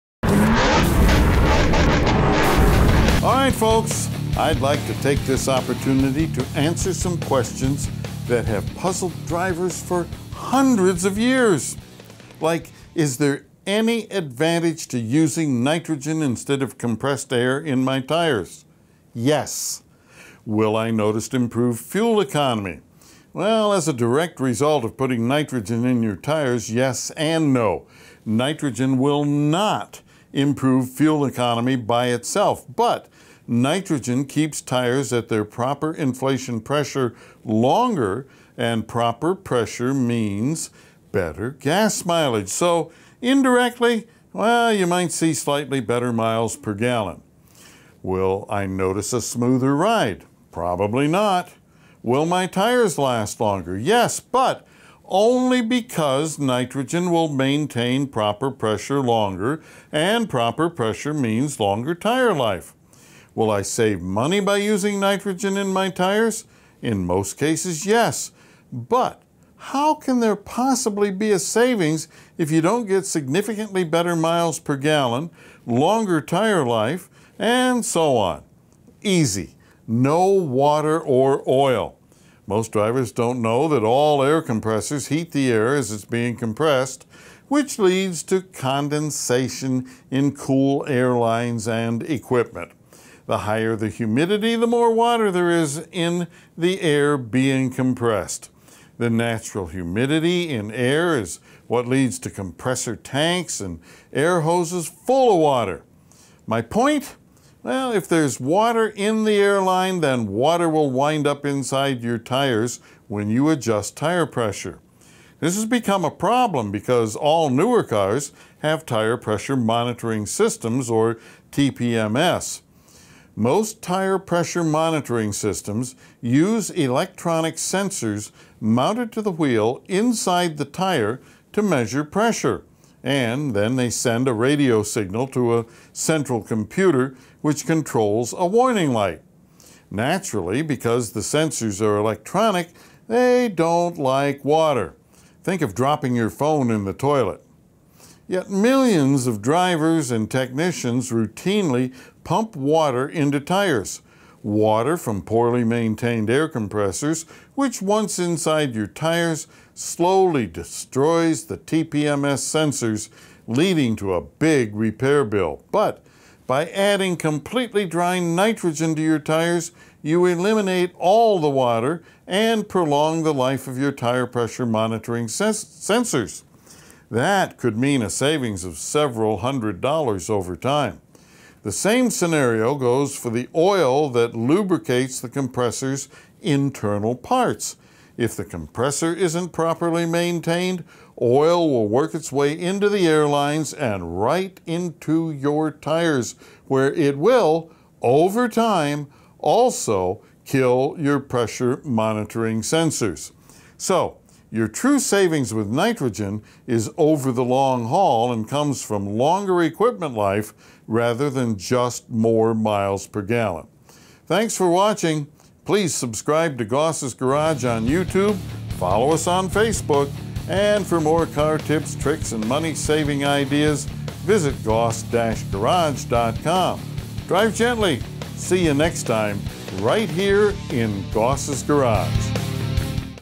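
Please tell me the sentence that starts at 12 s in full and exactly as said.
Like, is there any advantage to using nitrogen instead of compressed air in my tires?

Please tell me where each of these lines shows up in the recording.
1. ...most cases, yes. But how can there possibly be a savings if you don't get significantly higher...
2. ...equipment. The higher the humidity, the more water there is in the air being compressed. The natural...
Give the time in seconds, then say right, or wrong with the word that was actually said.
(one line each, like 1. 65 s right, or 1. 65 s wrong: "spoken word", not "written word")
1. 67 s wrong: "better", not "higher"
2. 92 s right.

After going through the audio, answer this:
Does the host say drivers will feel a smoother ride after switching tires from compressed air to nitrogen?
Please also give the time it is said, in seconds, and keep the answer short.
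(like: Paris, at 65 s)
Probably not, at 50 s.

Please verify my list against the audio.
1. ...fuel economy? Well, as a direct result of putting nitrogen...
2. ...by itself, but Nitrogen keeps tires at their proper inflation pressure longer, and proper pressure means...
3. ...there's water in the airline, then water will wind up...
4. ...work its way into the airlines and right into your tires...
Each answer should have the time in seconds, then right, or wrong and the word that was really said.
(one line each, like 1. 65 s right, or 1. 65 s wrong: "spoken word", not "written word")
1. 21 s right
2. 31 s right
3. 108 s right
4. 191 s right.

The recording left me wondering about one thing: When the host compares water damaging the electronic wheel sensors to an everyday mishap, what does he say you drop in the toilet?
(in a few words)
your phone.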